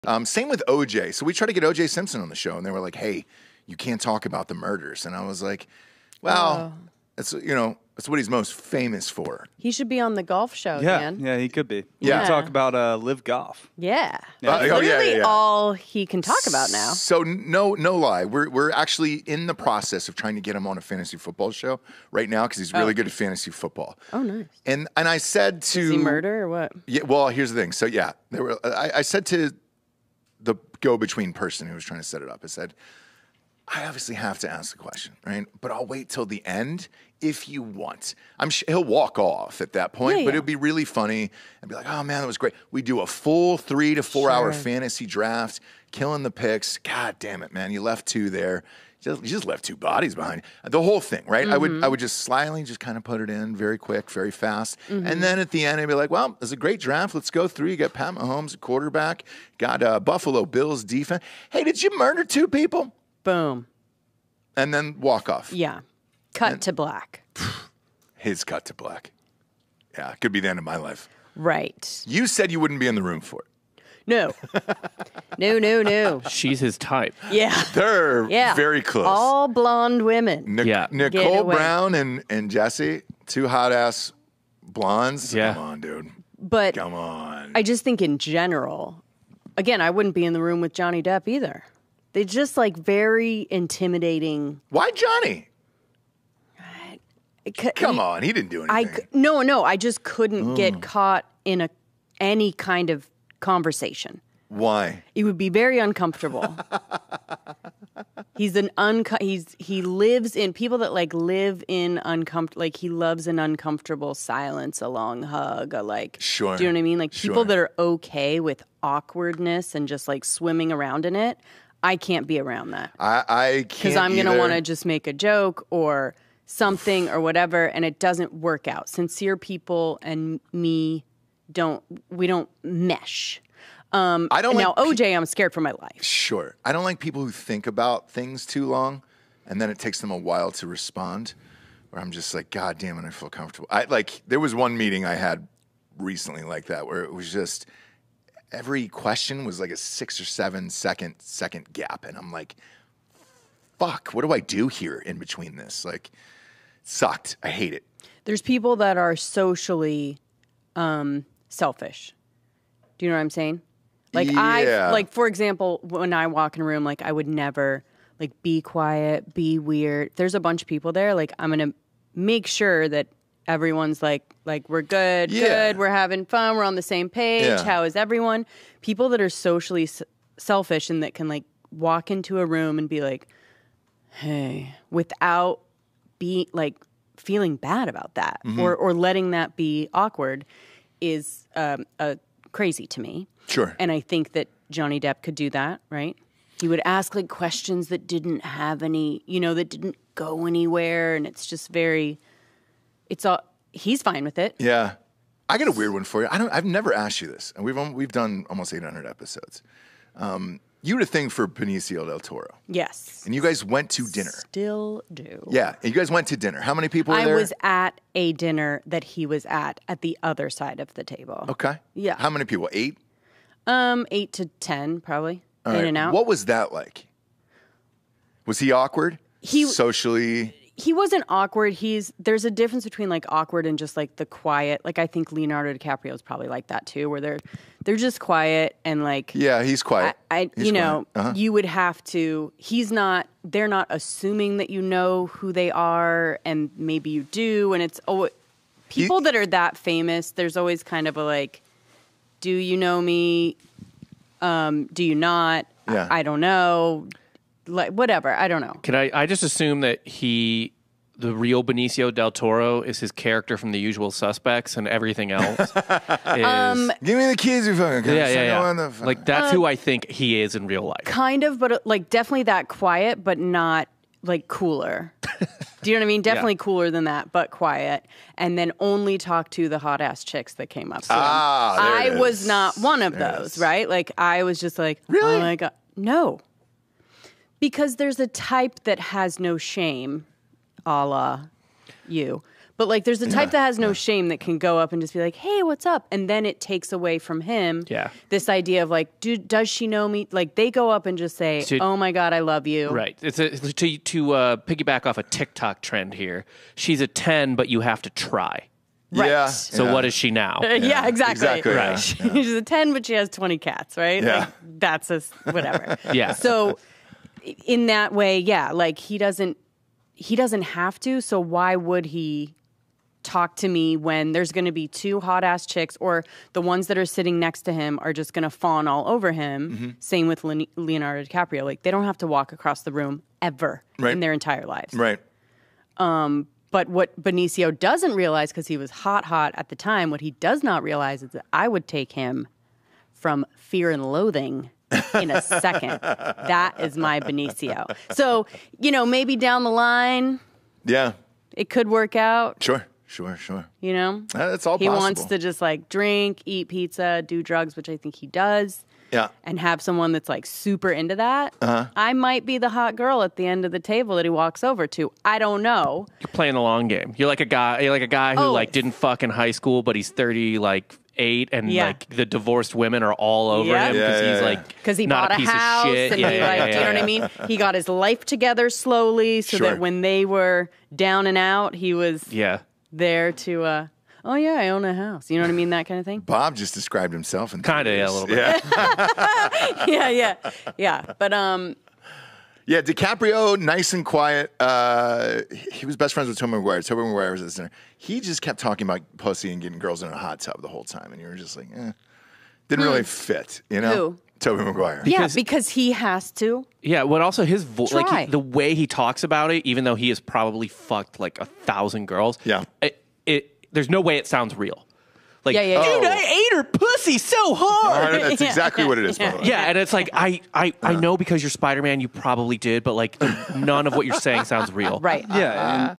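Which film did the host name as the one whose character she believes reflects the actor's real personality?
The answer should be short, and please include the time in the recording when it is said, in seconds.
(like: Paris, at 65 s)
The Usual Suspects, at 263 s.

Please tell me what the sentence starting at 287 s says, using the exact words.
Because there's a type that has no shame a la you.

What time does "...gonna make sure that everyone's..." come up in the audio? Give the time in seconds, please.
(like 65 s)
171 s.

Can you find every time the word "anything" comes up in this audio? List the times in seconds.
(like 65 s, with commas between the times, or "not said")
98 s.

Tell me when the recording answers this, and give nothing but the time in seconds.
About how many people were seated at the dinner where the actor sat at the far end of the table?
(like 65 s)
224 s.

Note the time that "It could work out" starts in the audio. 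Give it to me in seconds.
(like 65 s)
351 s.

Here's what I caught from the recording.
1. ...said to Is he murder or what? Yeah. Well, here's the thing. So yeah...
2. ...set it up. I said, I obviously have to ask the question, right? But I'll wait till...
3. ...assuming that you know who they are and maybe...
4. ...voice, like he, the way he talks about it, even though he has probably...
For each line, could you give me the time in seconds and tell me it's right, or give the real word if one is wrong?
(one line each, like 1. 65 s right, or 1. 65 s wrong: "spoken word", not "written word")
1. 25 s right
2. 32 s right
3. 243 s right
4. 407 s right.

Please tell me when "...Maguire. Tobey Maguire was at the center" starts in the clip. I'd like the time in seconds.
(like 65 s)
396 s.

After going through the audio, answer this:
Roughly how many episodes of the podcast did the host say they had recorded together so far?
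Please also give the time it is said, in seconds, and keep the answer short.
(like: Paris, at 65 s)
800, at 208 s.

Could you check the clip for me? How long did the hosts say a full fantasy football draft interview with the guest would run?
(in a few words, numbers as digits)
3 to 4 hours.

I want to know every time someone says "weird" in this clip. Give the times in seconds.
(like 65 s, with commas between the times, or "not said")
169 s, 205 s.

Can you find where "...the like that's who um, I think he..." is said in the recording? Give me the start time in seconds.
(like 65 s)
268 s.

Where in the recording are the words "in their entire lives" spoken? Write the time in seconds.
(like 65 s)
334 s.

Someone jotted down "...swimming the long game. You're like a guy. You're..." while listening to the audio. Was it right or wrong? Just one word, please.
wrong.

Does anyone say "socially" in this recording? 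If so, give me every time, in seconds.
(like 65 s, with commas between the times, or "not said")
159 s, 179 s, 229 s.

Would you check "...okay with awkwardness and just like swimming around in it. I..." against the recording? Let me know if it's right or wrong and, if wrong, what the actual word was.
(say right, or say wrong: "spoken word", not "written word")
right.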